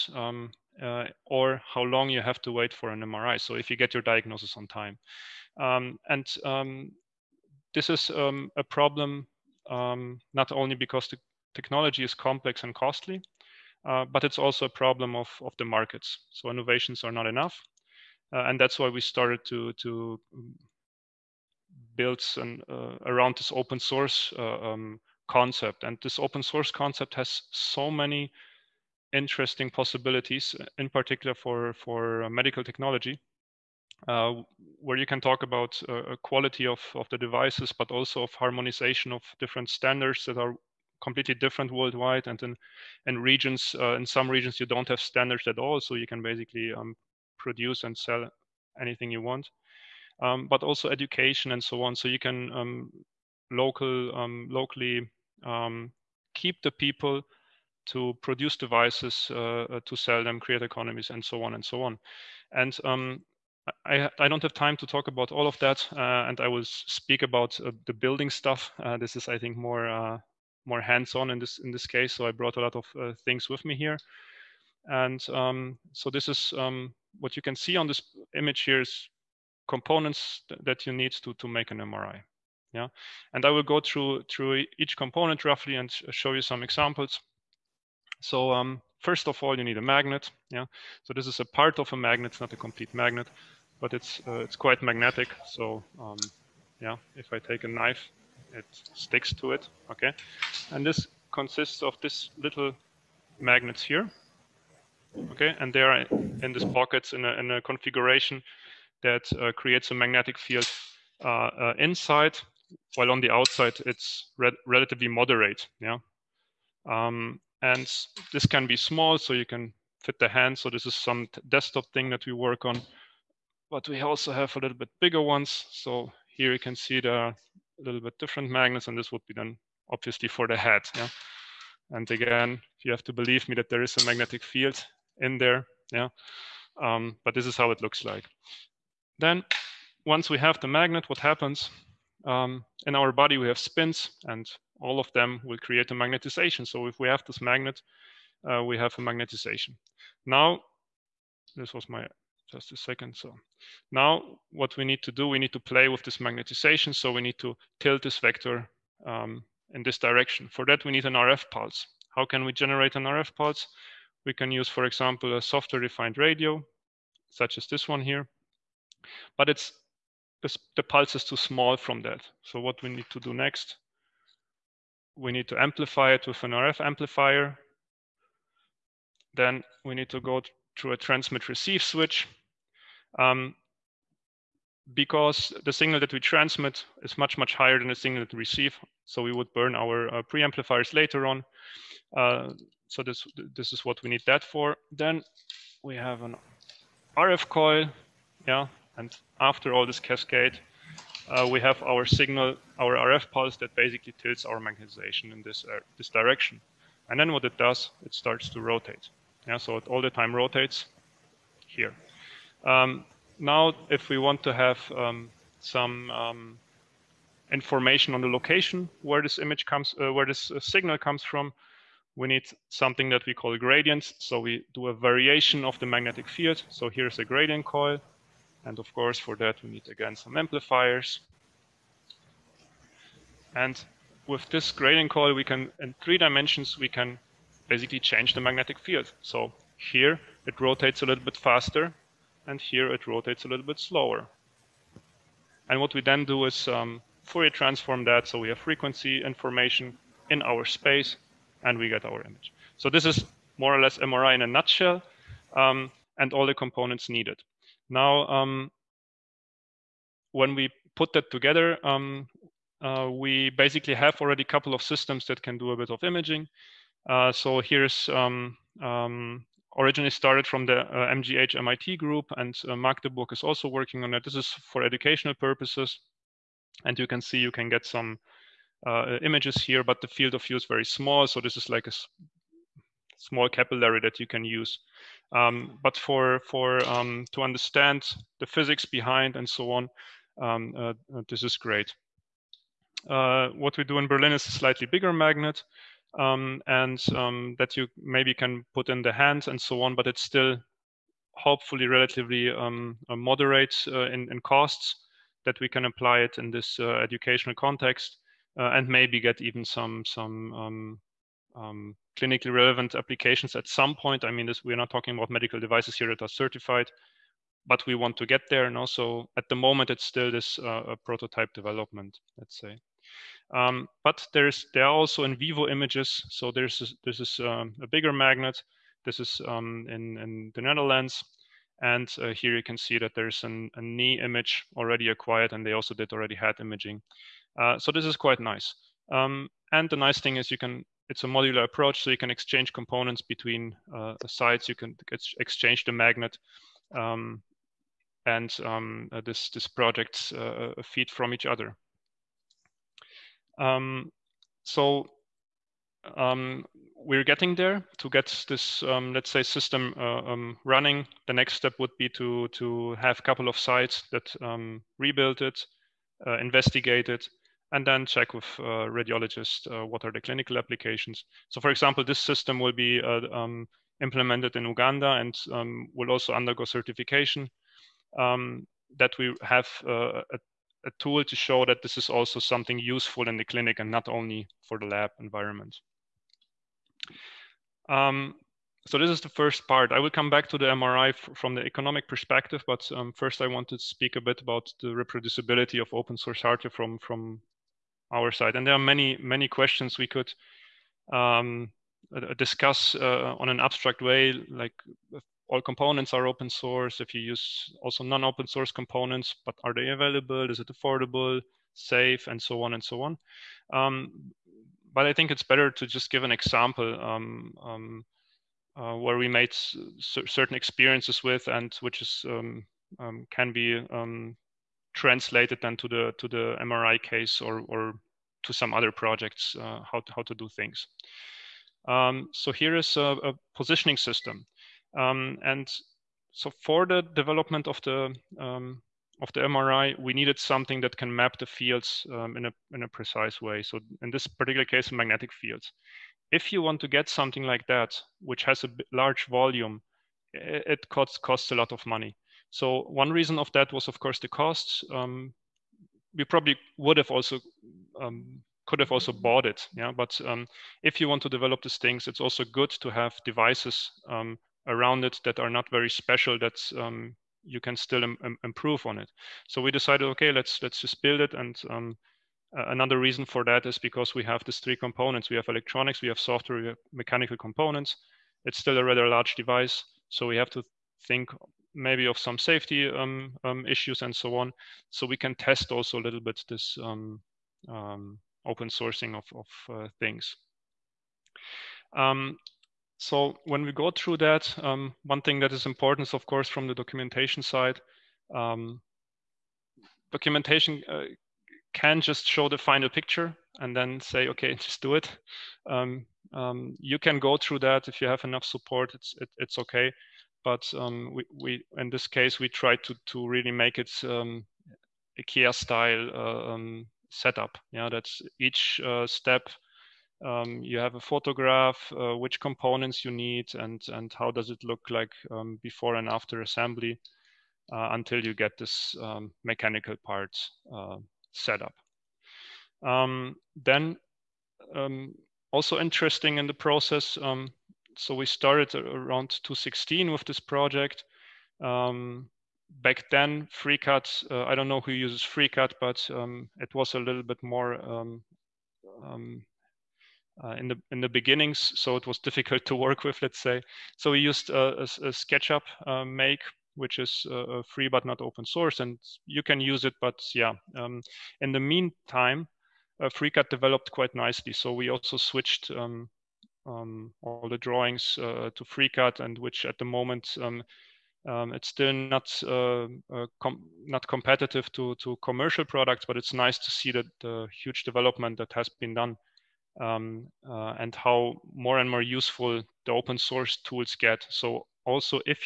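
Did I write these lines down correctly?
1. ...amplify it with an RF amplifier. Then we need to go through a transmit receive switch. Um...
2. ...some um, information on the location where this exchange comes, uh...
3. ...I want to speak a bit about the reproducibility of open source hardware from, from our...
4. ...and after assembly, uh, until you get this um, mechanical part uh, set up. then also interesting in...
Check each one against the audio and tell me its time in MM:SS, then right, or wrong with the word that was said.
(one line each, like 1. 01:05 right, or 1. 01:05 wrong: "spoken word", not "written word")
1. 02:55 right
2. 03:35 wrong: "image", not "exchange"
3. 06:33 right
4. 08:45 right.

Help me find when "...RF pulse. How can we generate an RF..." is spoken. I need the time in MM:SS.
02:41.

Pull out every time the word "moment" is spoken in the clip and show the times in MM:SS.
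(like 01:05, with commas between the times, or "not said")
05:19, 09:29.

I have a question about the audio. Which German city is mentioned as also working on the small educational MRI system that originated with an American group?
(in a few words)
Magdeburg.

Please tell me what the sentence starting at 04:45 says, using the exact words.
Um, but for for um, to understand the physics behind and so on, um, uh, uh this is great.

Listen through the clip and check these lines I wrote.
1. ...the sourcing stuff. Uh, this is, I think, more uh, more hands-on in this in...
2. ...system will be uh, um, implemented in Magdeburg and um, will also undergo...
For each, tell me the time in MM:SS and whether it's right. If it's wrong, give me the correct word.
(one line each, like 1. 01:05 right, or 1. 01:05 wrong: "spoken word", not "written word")
1. 01:07 wrong: "building", not "sourcing"
2. 06:12 wrong: "Uganda", not "Magdeburg".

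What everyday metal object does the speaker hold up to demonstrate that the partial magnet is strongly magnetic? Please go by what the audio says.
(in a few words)
knife.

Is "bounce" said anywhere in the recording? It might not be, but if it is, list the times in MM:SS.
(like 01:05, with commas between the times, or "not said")
not said.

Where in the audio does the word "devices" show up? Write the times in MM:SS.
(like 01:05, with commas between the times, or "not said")
00:37, 00:58, 05:15, 07:43, 07:59.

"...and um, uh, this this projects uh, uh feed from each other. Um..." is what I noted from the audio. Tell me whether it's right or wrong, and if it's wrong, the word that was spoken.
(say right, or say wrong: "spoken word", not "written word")
right.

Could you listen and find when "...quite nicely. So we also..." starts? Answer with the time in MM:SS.
09:23.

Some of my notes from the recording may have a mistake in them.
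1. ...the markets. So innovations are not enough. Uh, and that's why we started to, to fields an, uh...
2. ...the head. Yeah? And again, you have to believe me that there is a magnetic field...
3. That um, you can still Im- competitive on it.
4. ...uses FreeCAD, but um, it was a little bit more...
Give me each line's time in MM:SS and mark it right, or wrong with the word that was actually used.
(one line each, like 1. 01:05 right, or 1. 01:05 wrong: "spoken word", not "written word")
1. 00:15 wrong: "builds", not "fields"
2. 02:10 right
3. 07:46 wrong: "improve", not "competitive"
4. 09:04 right.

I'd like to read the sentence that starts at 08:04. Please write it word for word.
So we can test also a little bit this um, um, open sourcing of, of uh, things.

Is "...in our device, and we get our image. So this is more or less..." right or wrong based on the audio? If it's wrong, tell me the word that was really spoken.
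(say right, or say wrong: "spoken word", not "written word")
wrong: "space", not "device".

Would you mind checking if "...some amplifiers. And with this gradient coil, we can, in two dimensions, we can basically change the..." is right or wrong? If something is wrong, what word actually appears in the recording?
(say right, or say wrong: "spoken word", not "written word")
wrong: "three", not "two".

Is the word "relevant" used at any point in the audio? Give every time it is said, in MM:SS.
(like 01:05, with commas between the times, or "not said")
05:12.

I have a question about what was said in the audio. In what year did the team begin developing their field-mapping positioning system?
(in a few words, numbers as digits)
2016.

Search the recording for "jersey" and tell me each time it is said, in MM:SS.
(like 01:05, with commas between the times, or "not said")
not said.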